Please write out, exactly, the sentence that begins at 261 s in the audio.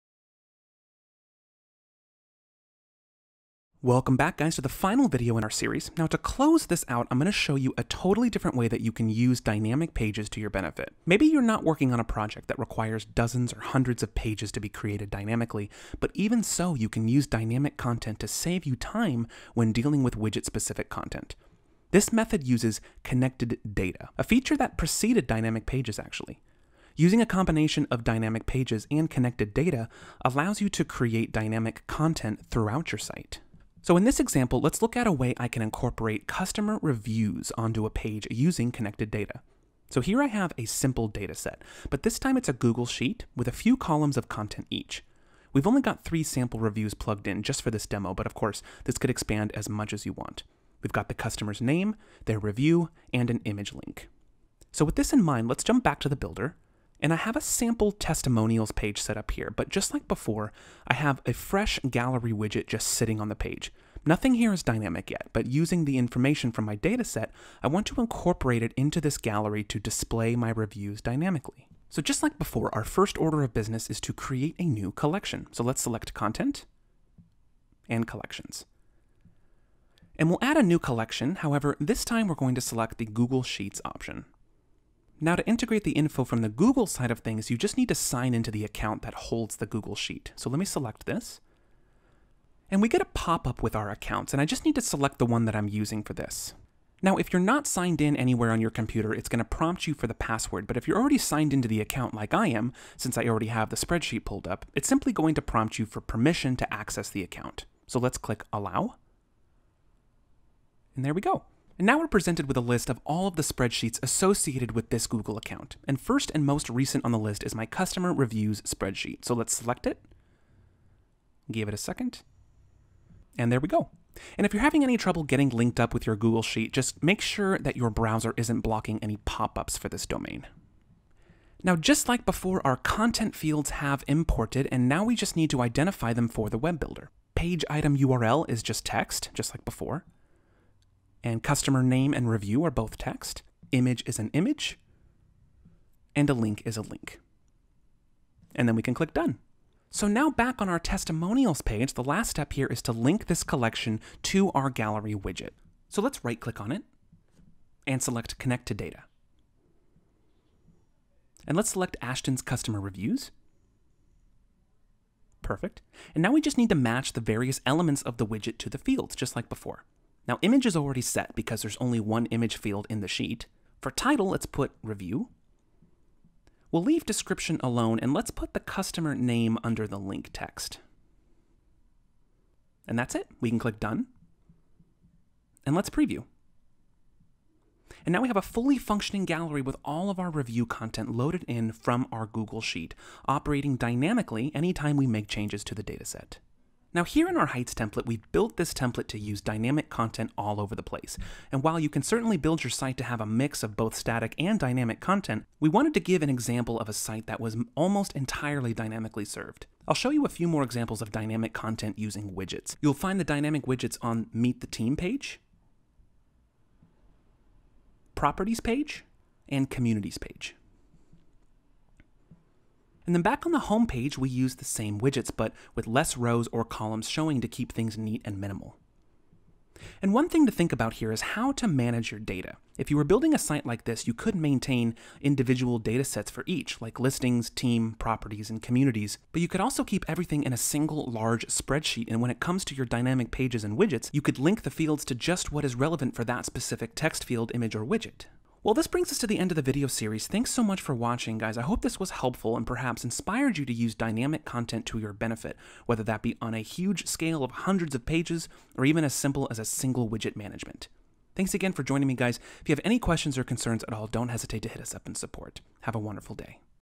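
Thanks again for joining me, guys.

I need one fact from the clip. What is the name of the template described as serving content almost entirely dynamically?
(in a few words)
Heights.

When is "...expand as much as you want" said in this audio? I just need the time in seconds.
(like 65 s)
49 s.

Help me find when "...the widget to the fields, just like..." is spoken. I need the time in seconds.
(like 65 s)
168 s.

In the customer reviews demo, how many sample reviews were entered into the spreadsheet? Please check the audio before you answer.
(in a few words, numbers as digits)
3.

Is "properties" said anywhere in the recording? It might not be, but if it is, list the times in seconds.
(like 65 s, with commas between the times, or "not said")
218 s, 237 s.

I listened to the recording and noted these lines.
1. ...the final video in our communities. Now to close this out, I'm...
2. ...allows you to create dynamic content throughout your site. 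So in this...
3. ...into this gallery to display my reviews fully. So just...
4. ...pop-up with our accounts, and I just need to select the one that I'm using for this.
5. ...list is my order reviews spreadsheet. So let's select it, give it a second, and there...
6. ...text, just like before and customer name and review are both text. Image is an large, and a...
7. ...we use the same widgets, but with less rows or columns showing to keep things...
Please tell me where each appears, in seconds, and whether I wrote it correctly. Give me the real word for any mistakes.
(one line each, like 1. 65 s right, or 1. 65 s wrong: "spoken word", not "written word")
1. 4 s wrong: "series", not "communities"
2. 30 s right
3. 68 s wrong: "dynamically", not "fully"
4. 93 s right
5. 117 s wrong: "customer", not "order"
6. 138 s wrong: "image", not "large"
7. 224 s right.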